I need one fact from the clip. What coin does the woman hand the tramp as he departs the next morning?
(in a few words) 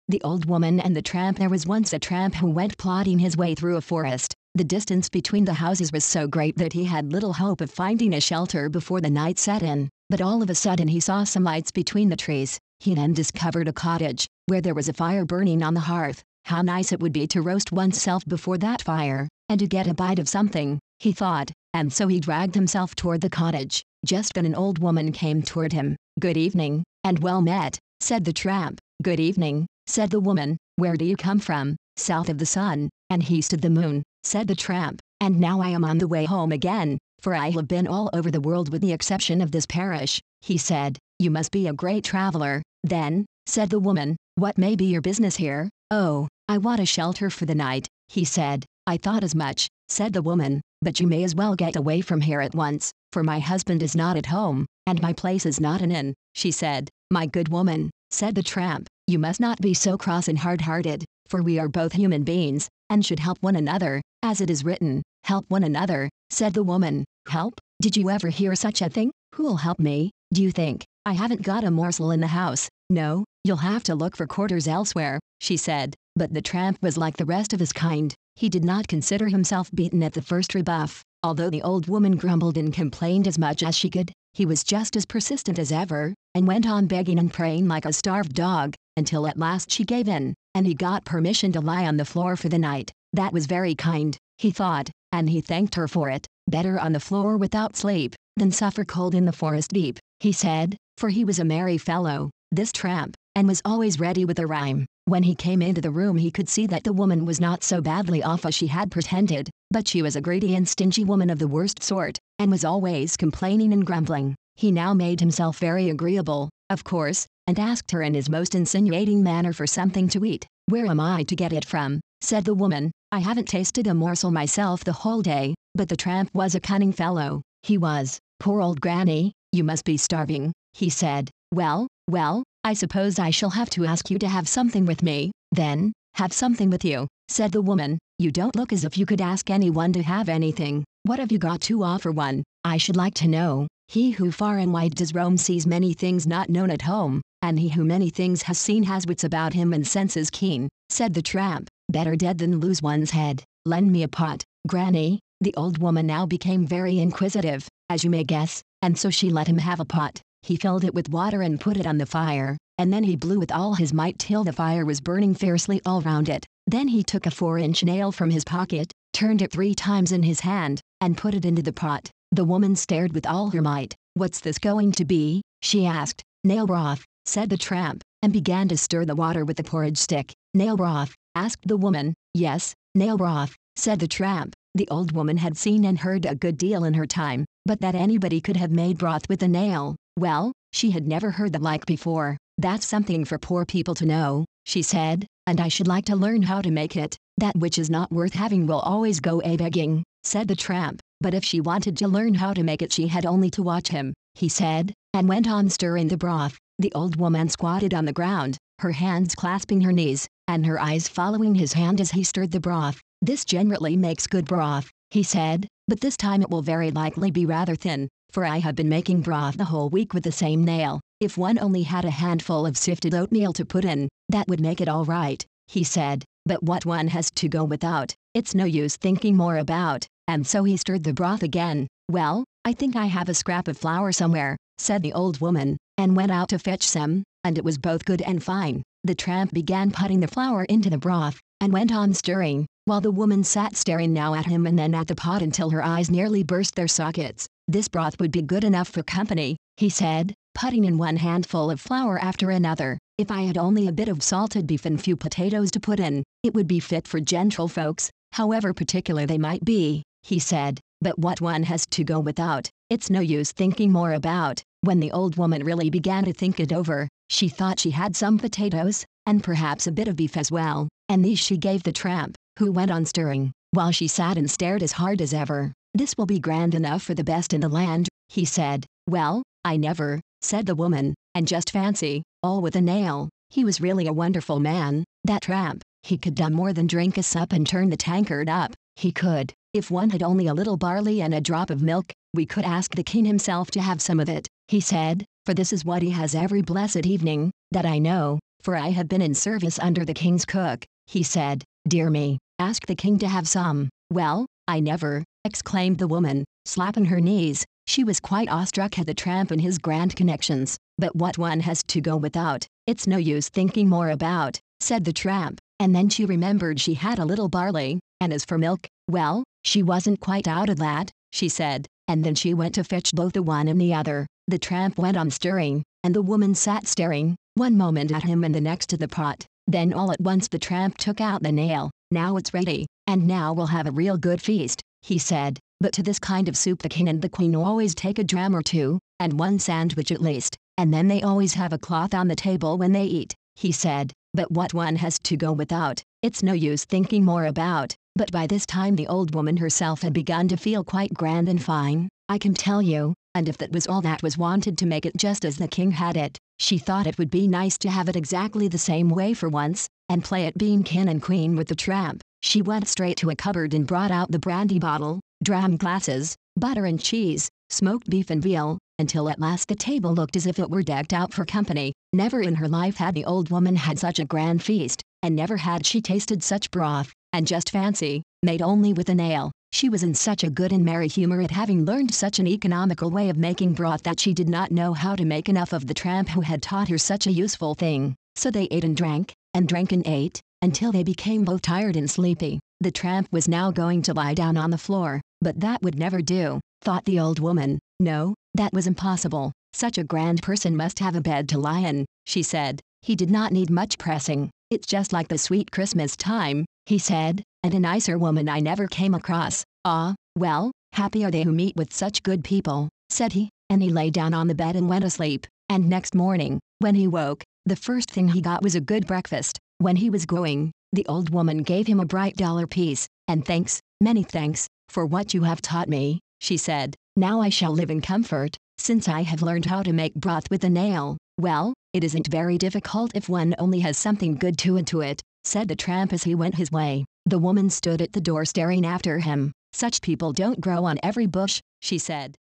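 A bright dollar piece.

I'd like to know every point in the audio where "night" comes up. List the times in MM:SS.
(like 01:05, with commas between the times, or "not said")
00:09, 00:47, 01:32.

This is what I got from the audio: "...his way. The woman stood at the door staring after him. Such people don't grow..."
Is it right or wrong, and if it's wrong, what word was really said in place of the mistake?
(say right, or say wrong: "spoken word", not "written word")
right.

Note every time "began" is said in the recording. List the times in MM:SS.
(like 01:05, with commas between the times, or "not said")
02:58, 03:59, 04:25.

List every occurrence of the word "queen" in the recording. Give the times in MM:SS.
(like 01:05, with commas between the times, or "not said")
05:37, 06:01.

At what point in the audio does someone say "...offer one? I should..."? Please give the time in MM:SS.
02:21.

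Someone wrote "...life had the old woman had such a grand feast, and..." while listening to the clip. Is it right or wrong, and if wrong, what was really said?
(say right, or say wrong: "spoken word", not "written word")
right.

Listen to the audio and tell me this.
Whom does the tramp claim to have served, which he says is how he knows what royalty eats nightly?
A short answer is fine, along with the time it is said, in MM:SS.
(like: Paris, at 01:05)
The king's cook, at 05:00.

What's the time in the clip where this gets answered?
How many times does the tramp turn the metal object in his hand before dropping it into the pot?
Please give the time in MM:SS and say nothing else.
02:49.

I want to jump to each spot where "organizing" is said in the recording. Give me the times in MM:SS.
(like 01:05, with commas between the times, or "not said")
not said.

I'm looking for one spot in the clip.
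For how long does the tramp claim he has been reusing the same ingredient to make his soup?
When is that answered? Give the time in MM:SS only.
03:39.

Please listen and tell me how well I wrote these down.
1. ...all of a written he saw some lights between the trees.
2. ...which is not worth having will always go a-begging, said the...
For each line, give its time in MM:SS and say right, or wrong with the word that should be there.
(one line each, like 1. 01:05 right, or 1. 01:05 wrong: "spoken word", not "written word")
1. 00:10 wrong: "sudden", not "written"
2. 03:17 right.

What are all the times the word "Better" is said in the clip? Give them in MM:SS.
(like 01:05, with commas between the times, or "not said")
01:36, 02:31.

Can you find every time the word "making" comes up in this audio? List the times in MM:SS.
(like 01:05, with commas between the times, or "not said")
03:38, 06:23.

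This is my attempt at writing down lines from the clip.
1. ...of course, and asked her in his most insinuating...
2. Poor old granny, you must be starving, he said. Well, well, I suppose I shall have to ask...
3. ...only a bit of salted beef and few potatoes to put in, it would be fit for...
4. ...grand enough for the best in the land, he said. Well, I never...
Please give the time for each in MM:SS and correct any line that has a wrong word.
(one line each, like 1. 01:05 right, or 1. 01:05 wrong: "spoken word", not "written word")
1. 01:56 right
2. 02:08 right
3. 04:13 right
4. 04:36 right.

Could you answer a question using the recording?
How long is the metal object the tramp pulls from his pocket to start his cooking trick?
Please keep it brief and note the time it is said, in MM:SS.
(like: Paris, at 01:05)
4 inches, at 02:47.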